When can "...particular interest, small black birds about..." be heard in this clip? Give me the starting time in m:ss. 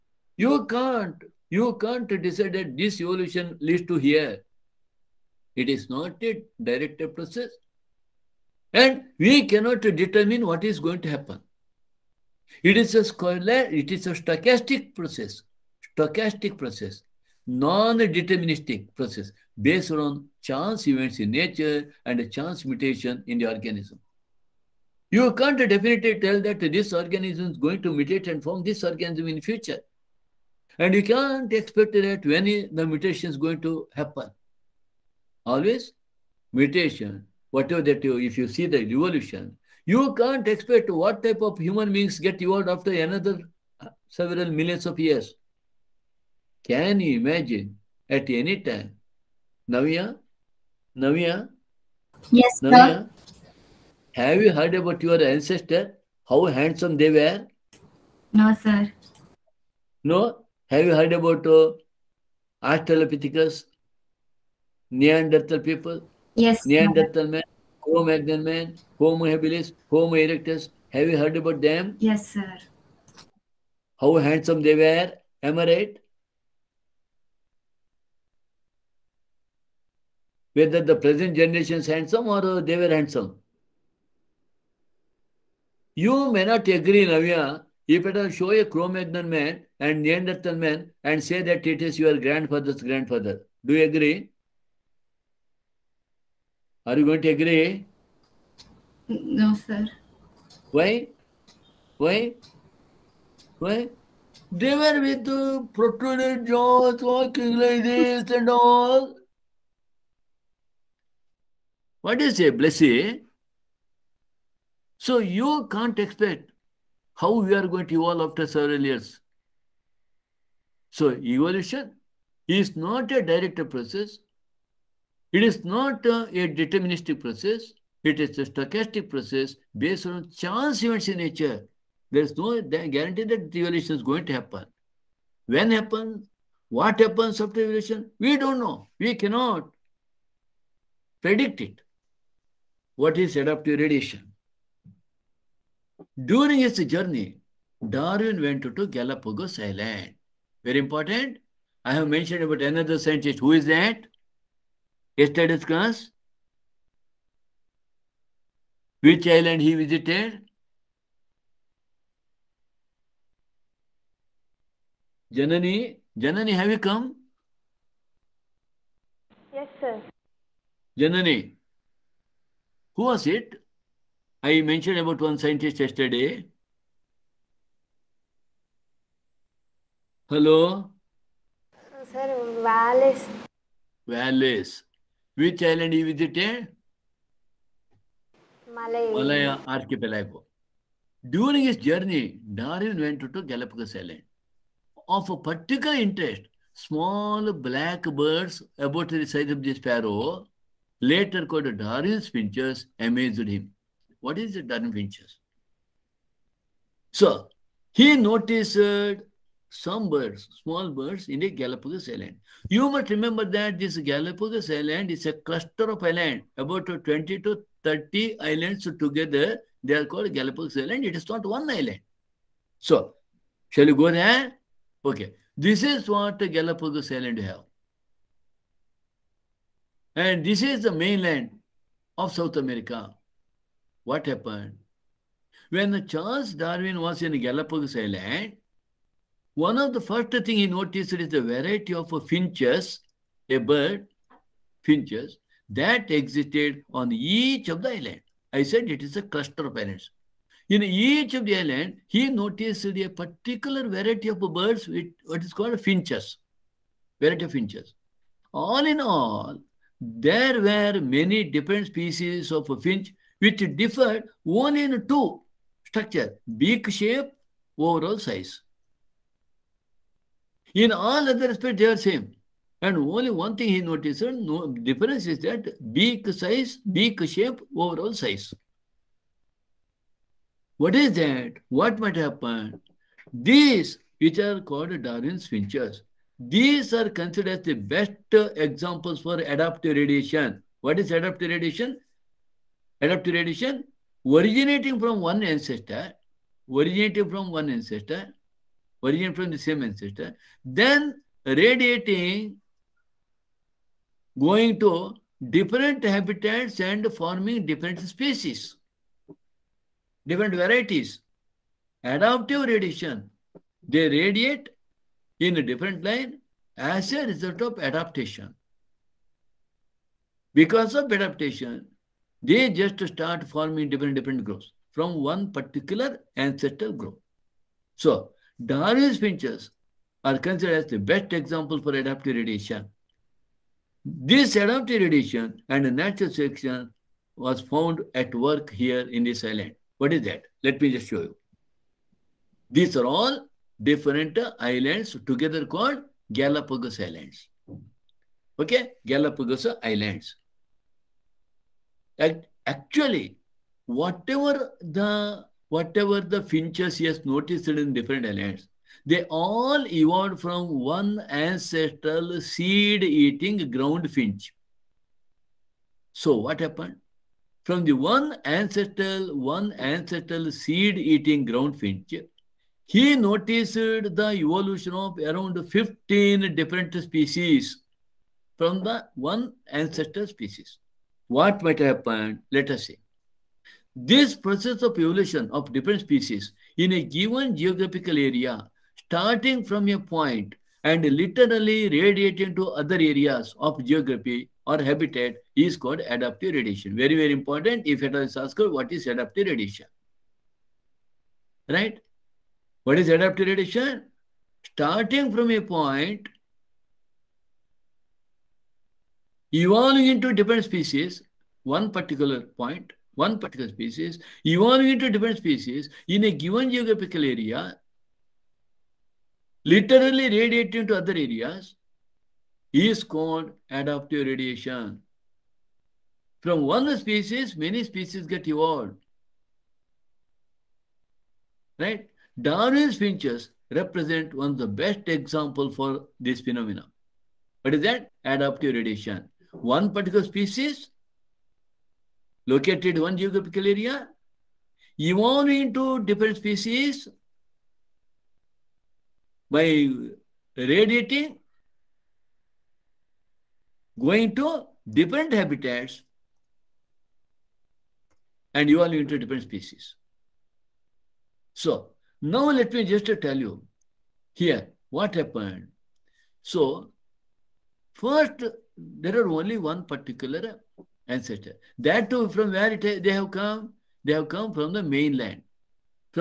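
3:15.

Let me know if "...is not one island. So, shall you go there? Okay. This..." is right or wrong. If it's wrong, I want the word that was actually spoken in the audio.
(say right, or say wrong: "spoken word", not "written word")
right.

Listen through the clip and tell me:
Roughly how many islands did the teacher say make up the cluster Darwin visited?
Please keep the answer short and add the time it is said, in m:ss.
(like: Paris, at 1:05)
20 to 30, at 3:36.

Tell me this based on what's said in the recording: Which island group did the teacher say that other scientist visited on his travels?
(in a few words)
Malaya archipelago.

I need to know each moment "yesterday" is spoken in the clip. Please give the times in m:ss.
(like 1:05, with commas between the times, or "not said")
2:35, 2:55.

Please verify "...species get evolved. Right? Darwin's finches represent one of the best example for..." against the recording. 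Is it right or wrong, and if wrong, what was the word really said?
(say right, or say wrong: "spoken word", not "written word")
right.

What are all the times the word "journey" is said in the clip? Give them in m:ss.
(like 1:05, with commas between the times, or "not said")
2:26, 3:11.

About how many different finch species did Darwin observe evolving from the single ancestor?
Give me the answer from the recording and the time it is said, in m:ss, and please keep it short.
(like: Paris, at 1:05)
15, at 6:15.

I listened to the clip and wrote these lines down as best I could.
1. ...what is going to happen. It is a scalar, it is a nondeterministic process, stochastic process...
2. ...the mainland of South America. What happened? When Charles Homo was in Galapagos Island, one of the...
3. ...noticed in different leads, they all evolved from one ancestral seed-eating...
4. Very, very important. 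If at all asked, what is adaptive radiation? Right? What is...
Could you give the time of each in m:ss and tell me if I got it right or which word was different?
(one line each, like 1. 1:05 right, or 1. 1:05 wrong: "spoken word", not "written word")
1. 0:10 wrong: "stochastic", not "nondeterministic"
2. 3:50 wrong: "Darwin", not "Homo"
3. 5:57 wrong: "islands", not "leads"
4. 6:36 right.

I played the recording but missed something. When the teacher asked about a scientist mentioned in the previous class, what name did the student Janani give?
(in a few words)
Wallace.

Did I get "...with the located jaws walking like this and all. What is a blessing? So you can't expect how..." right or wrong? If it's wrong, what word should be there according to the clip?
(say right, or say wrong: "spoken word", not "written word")
wrong: "protruded", not "located".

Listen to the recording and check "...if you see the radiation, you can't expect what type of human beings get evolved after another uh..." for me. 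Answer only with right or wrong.
wrong.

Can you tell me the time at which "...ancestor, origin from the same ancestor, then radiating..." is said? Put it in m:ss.
4:57.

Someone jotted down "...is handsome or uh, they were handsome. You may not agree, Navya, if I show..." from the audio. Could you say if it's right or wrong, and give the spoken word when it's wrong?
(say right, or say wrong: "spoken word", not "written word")
right.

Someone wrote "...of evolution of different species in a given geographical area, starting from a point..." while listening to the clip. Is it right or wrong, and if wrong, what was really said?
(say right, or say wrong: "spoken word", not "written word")
right.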